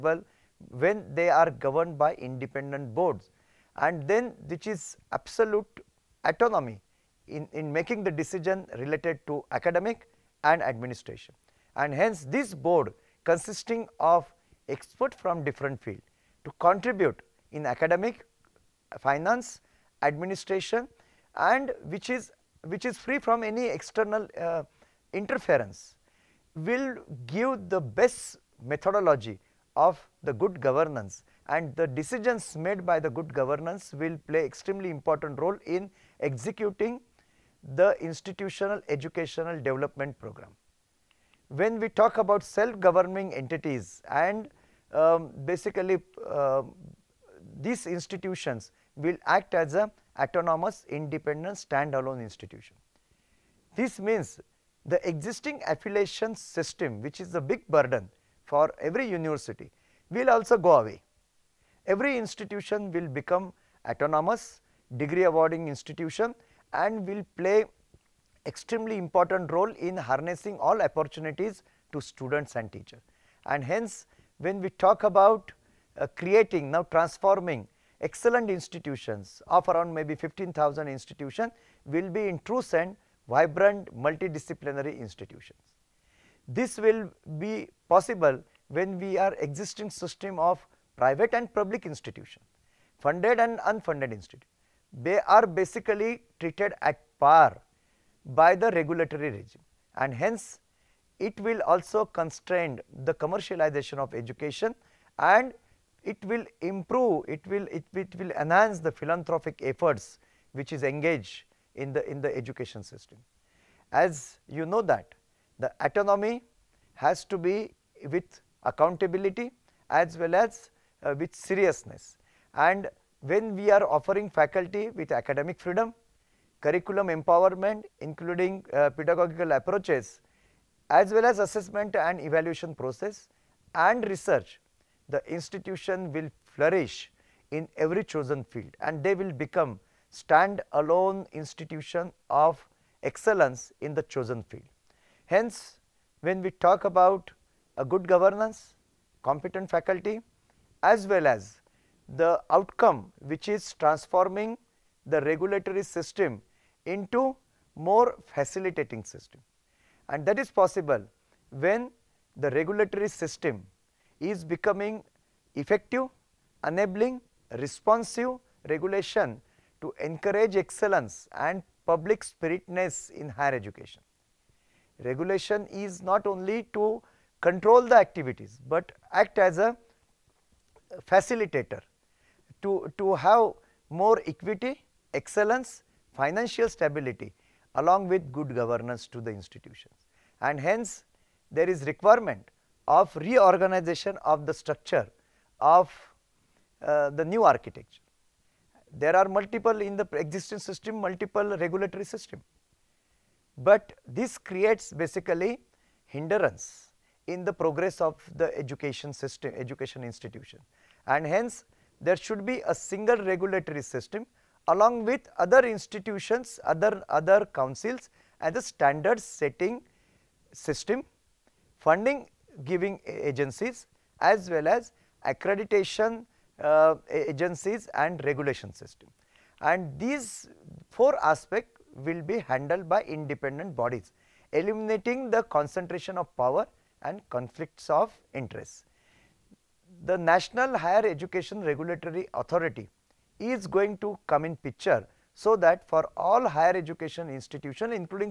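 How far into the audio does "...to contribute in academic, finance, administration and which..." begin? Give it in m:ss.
0:16.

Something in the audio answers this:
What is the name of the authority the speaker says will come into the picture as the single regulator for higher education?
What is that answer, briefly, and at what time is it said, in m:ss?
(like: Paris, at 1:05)
National Higher Education Regulatory Authority, at 4:00.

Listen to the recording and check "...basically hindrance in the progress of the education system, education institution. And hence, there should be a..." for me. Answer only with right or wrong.
right.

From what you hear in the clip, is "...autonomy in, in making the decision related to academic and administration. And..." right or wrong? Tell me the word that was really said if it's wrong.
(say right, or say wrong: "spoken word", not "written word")
right.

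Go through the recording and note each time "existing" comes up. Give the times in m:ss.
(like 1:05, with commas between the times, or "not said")
0:55, 1:29, 3:20.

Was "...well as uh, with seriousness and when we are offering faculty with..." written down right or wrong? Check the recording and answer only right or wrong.
right.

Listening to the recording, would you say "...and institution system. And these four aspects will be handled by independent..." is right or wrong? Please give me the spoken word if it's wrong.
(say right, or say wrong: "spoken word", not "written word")
wrong: "regulation", not "institution".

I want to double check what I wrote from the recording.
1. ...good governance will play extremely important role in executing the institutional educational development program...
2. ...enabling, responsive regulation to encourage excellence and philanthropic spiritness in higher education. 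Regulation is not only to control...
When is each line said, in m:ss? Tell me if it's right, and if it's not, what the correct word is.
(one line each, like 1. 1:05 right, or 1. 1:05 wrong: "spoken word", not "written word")
1. 0:33 right
2. 2:46 wrong: "public", not "philanthropic".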